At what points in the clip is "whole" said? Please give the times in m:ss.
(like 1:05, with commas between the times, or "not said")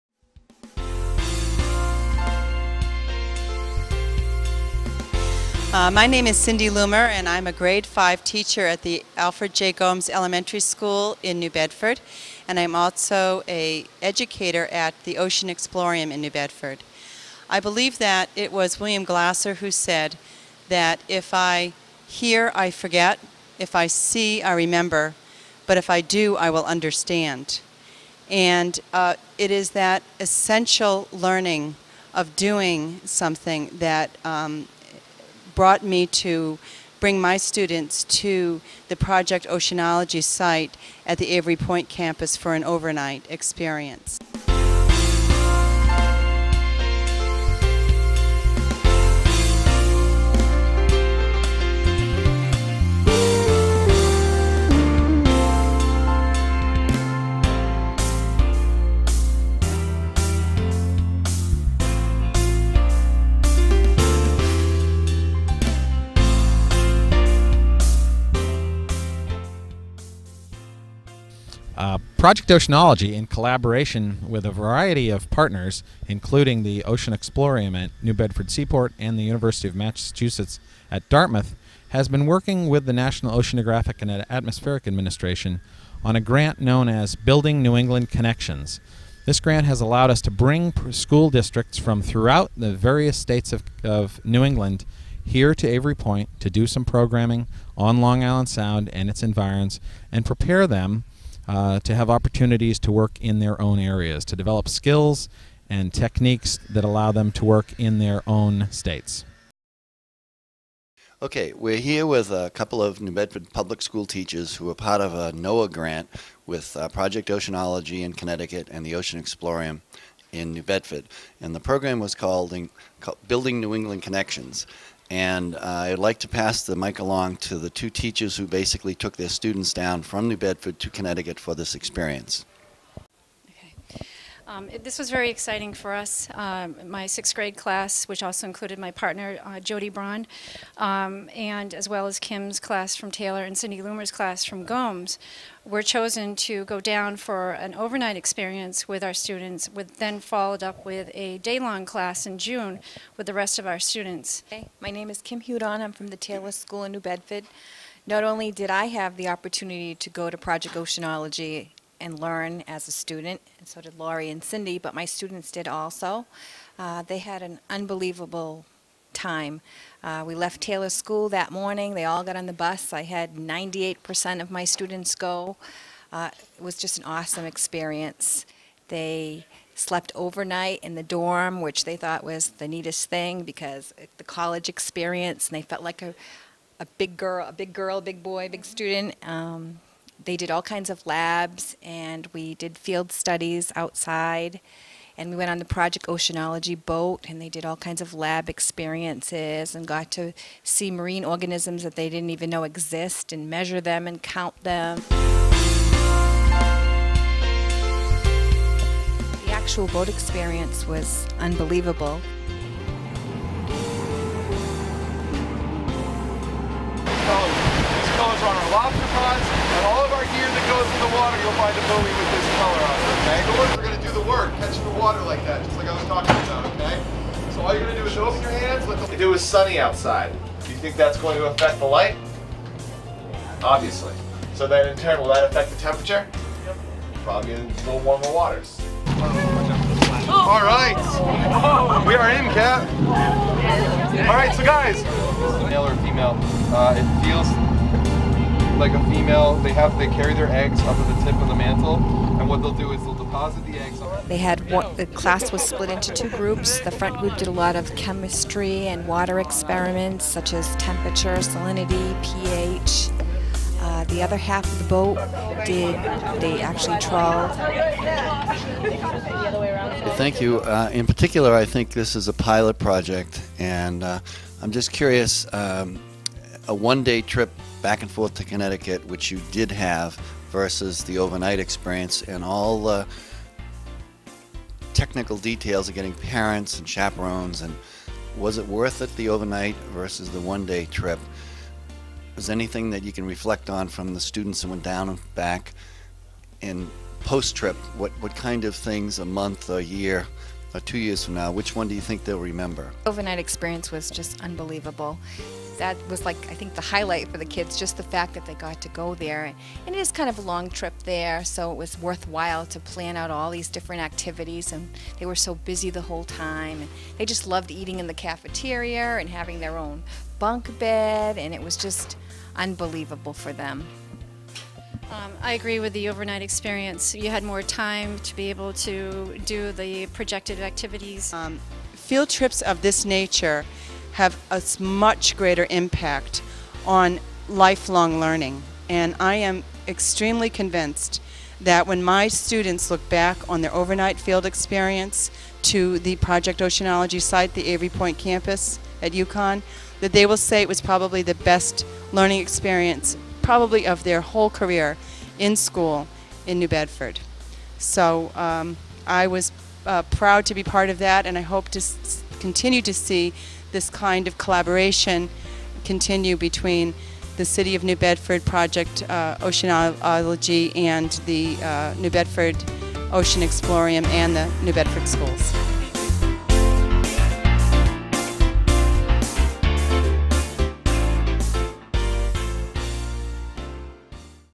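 5:16, 5:54.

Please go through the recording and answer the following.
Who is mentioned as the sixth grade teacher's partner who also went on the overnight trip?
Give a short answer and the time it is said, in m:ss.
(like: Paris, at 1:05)
Jody Braun, at 2:19.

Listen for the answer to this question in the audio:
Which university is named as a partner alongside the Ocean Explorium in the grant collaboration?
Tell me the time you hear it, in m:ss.
1:19.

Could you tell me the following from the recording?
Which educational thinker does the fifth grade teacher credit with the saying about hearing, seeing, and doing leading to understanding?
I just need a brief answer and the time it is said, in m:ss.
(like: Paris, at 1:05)
William Glasser, at 0:18.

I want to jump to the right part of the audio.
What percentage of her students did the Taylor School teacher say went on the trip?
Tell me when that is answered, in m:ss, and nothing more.
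2:53.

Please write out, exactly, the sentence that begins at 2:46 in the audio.
Uh, they had an unbelievable time.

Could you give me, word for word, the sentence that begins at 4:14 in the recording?
They had one, the class was split into two groups.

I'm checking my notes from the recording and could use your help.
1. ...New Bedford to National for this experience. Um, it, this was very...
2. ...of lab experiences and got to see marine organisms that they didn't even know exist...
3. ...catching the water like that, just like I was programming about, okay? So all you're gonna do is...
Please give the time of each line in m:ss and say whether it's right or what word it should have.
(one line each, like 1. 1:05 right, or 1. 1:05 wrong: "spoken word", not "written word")
1. 2:10 wrong: "Connecticut", not "National"
2. 3:18 right
3. 3:44 wrong: "talking", not "programming".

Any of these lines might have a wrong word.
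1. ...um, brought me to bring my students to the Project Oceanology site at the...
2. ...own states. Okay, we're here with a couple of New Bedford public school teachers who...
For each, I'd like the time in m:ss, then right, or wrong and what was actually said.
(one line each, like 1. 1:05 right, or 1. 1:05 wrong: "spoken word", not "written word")
1. 0:34 right
2. 1:48 right.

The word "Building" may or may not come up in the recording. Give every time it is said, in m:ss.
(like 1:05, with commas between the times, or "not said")
1:27, 2:03.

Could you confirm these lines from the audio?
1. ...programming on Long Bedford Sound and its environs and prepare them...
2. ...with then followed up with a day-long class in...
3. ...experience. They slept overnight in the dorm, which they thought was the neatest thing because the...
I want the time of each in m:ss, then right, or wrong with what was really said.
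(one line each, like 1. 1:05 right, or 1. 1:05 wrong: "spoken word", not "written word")
1. 1:36 wrong: "Island", not "Bedford"
2. 2:29 right
3. 2:57 right.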